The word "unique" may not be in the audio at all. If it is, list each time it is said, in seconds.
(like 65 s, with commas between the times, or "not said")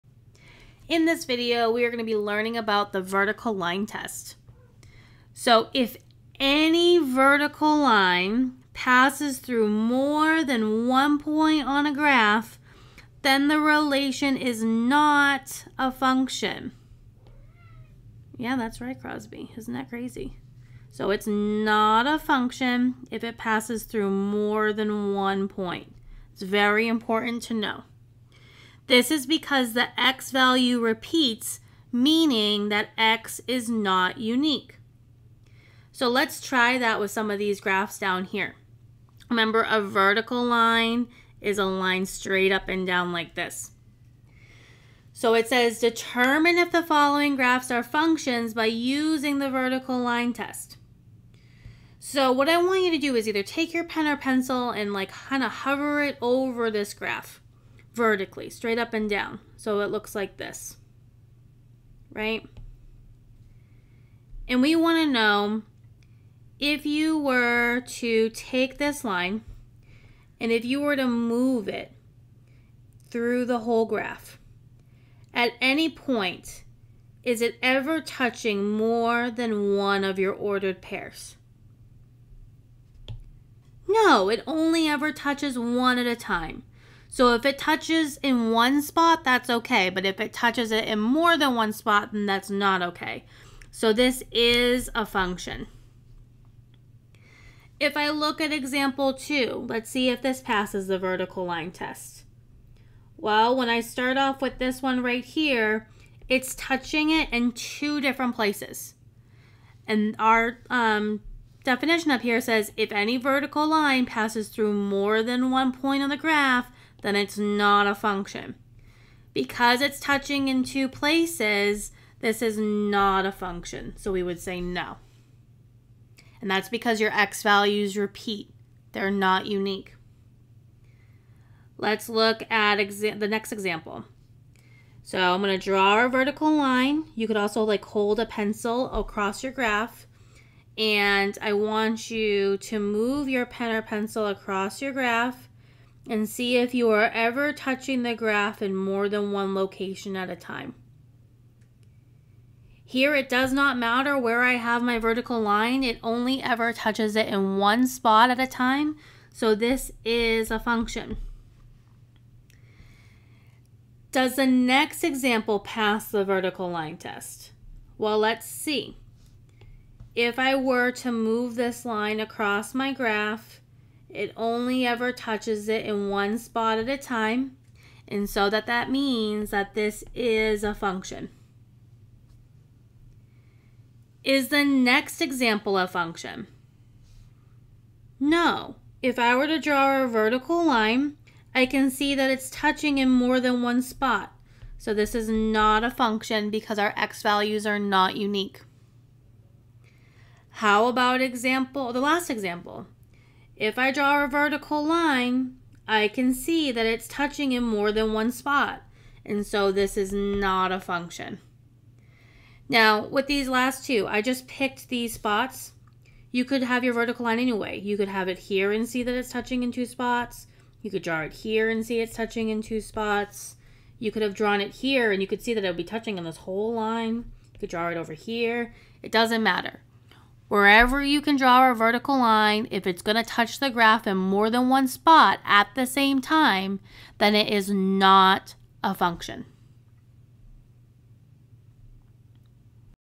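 34 s, 129 s, 198 s.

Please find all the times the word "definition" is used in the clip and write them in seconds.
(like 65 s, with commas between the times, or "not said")
111 s.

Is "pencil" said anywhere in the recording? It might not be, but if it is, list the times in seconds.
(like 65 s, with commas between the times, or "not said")
54 s, 138 s, 143 s.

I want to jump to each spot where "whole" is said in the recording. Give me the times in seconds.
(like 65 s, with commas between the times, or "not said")
73 s, 226 s.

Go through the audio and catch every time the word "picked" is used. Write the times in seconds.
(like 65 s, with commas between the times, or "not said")
214 s.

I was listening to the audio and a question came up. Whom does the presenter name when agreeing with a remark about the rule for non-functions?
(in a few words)
Crosby.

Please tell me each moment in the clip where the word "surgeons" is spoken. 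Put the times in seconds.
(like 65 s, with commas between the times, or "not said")
not said.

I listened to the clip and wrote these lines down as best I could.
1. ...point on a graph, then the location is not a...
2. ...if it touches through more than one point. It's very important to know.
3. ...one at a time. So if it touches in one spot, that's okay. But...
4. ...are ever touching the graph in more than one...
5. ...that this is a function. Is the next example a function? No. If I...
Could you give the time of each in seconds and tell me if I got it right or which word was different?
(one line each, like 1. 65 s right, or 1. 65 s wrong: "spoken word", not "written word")
1. 11 s wrong: "relation", not "location"
2. 23 s wrong: "passes", not "touches"
3. 85 s right
4. 146 s right
5. 179 s right.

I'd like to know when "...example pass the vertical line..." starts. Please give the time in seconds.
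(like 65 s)
165 s.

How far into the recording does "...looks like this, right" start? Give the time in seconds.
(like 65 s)
59 s.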